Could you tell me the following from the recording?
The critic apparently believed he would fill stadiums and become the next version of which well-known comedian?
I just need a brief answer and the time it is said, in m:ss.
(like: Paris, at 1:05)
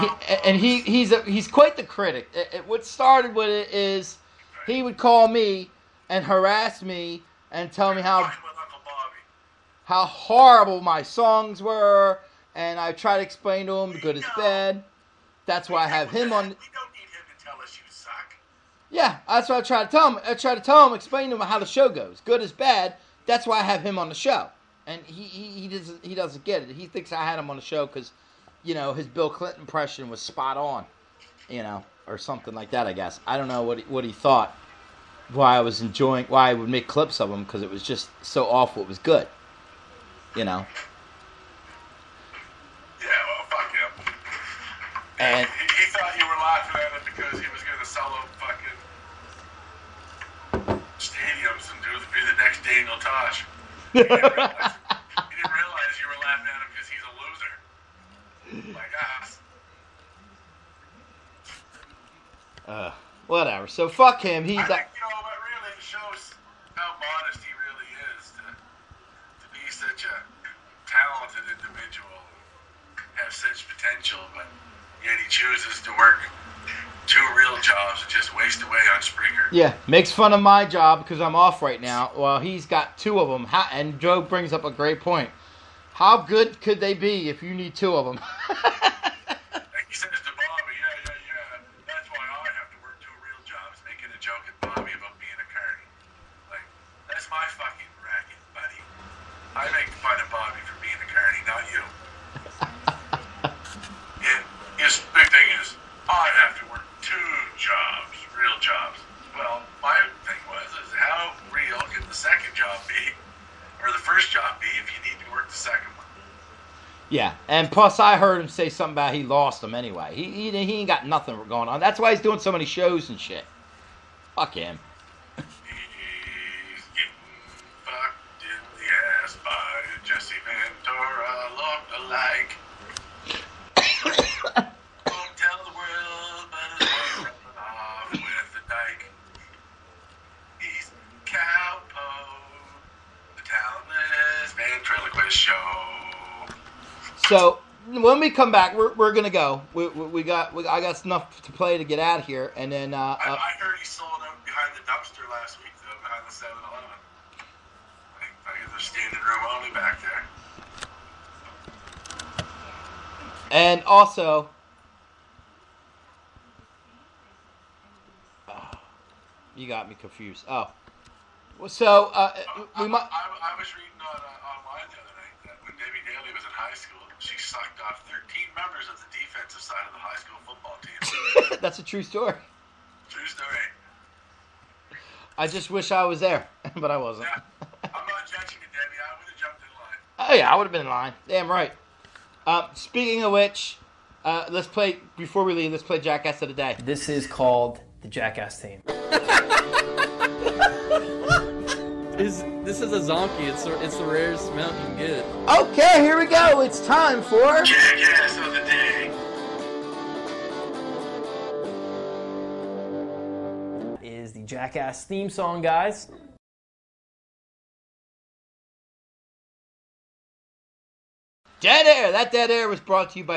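Daniel Tosh, at 0:52.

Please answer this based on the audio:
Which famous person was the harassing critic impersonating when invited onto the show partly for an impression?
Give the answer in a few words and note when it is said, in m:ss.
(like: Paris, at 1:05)
Bill Clinton, at 0:29.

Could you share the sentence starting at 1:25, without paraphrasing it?
How good could they be if you need two of them?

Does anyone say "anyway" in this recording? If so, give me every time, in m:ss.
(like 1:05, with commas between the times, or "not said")
1:59.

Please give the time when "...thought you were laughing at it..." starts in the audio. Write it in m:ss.
0:45.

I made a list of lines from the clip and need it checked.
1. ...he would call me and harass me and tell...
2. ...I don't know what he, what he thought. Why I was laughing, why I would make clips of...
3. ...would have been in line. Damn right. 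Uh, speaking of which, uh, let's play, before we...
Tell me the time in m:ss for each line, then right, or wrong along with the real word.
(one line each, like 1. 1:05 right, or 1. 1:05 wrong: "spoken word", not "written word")
1. 0:04 right
2. 0:33 wrong: "enjoying", not "laughing"
3. 3:10 right.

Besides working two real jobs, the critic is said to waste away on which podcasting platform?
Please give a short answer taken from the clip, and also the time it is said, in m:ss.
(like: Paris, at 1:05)
Spreaker, at 1:19.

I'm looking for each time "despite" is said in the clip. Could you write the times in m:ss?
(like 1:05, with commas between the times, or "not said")
not said.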